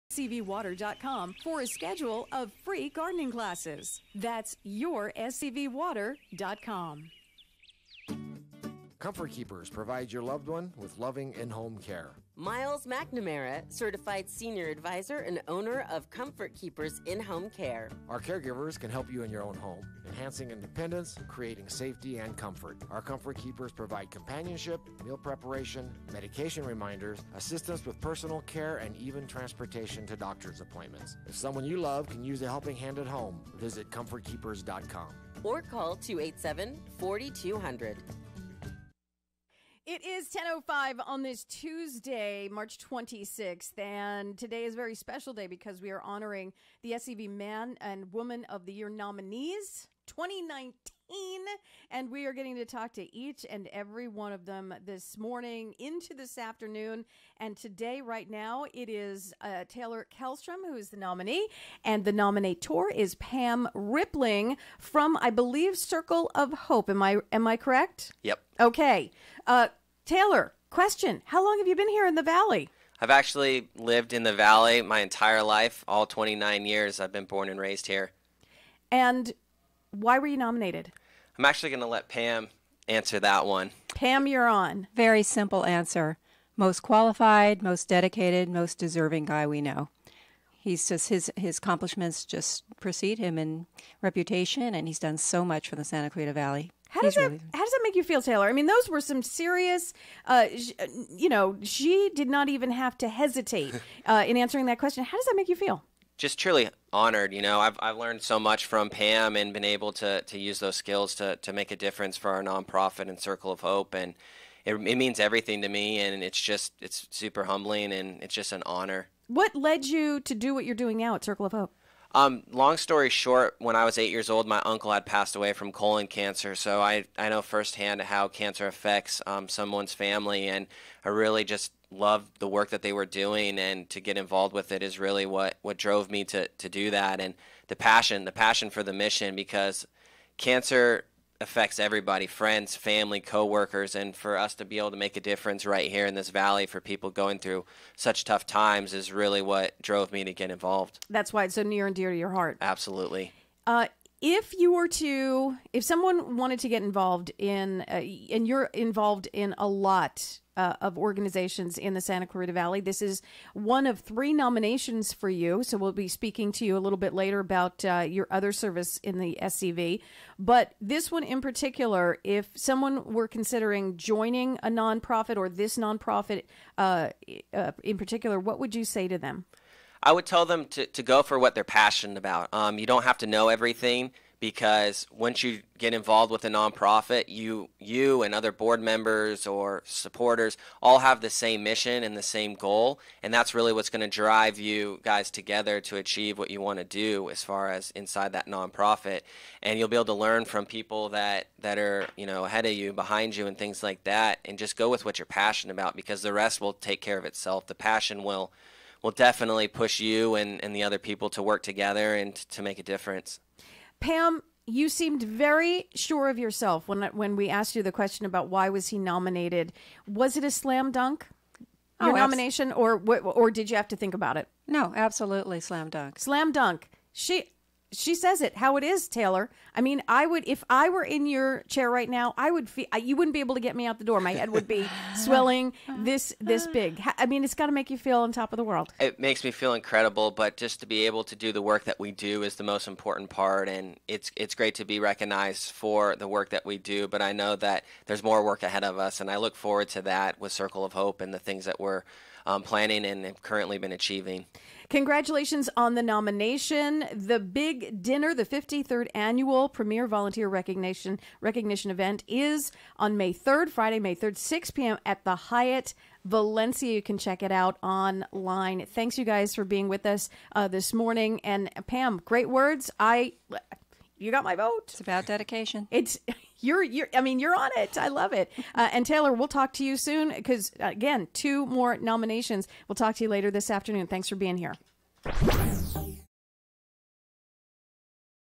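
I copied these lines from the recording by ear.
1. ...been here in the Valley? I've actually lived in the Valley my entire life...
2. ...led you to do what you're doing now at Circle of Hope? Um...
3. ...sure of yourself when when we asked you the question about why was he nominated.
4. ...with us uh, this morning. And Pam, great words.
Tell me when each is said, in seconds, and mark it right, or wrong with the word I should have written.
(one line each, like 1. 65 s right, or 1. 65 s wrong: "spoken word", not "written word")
1. 71 s right
2. 119 s right
3. 215 s right
4. 269 s right.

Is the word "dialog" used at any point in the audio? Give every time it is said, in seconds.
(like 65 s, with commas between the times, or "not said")
not said.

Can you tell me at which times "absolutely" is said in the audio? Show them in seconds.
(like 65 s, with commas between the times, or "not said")
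152 s, 224 s.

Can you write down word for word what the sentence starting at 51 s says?
And we are getting to talk to each and every one of them this morning into this afternoon.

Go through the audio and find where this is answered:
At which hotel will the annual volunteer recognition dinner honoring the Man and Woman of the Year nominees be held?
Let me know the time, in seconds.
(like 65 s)
265 s.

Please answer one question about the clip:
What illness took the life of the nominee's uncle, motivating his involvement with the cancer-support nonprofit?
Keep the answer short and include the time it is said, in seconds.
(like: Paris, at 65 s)
colon cancer, at 125 s.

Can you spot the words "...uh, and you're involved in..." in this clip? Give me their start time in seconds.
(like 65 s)
157 s.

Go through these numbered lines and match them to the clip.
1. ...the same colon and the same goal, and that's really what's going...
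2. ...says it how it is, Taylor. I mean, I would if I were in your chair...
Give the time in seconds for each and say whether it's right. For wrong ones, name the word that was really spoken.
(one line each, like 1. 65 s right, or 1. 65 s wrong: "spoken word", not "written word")
1. 191 s wrong: "mission", not "colon"
2. 228 s right.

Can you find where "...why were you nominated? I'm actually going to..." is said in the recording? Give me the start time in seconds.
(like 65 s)
79 s.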